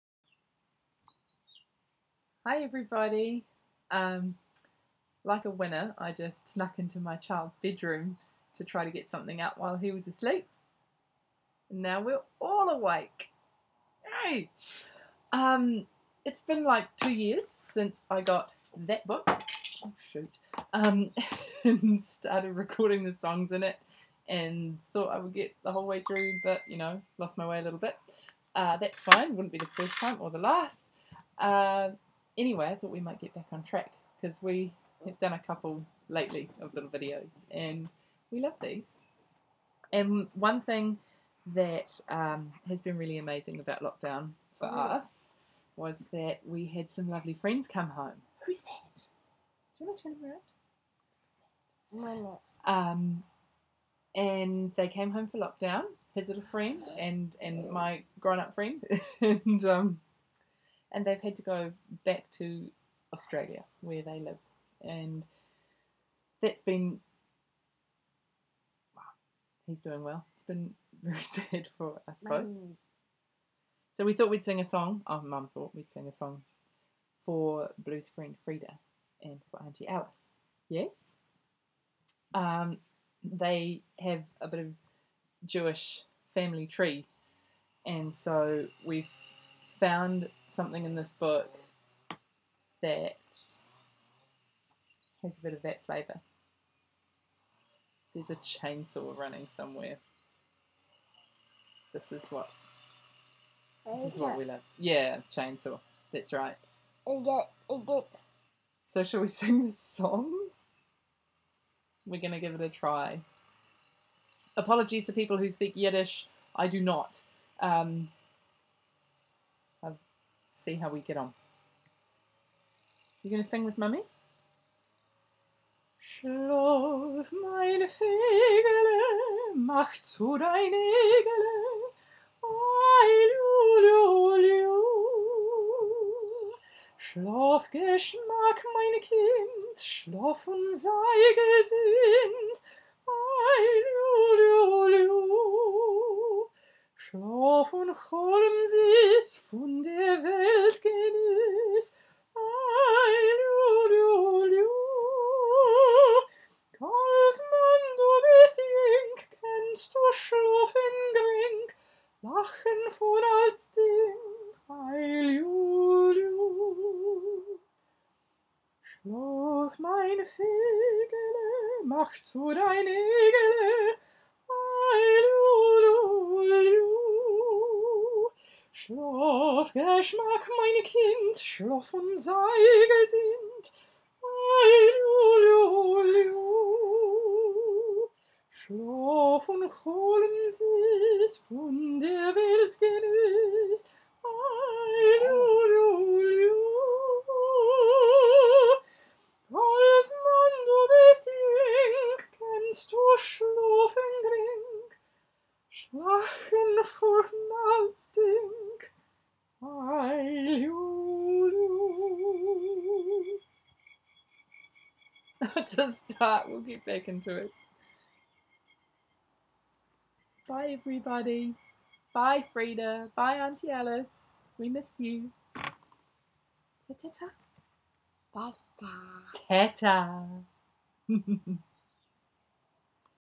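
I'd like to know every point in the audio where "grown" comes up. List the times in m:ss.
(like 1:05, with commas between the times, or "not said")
0:58.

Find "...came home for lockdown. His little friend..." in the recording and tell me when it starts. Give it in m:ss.
0:54.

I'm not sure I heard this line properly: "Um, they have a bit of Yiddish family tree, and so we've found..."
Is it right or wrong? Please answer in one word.
wrong.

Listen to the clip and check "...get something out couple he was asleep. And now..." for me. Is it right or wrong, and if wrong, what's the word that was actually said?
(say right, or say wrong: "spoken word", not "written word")
wrong: "while", not "couple".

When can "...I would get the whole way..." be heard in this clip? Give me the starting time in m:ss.
0:25.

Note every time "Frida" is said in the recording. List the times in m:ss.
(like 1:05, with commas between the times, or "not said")
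1:18, 3:42.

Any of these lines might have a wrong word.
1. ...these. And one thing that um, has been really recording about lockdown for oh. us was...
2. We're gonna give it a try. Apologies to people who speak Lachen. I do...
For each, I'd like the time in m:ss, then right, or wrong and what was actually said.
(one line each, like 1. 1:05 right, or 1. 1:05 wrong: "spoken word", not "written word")
1. 0:38 wrong: "amazing", not "recording"
2. 1:52 wrong: "Yiddish", not "Lachen".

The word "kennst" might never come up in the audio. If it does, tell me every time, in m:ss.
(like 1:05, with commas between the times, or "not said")
2:39, 3:22.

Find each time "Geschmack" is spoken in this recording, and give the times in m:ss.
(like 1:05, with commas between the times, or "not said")
2:17, 2:59.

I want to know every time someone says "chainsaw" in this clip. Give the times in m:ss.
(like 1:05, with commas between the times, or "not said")
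1:38, 1:45.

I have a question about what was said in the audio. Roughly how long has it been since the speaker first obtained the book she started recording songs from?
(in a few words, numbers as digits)
2 years.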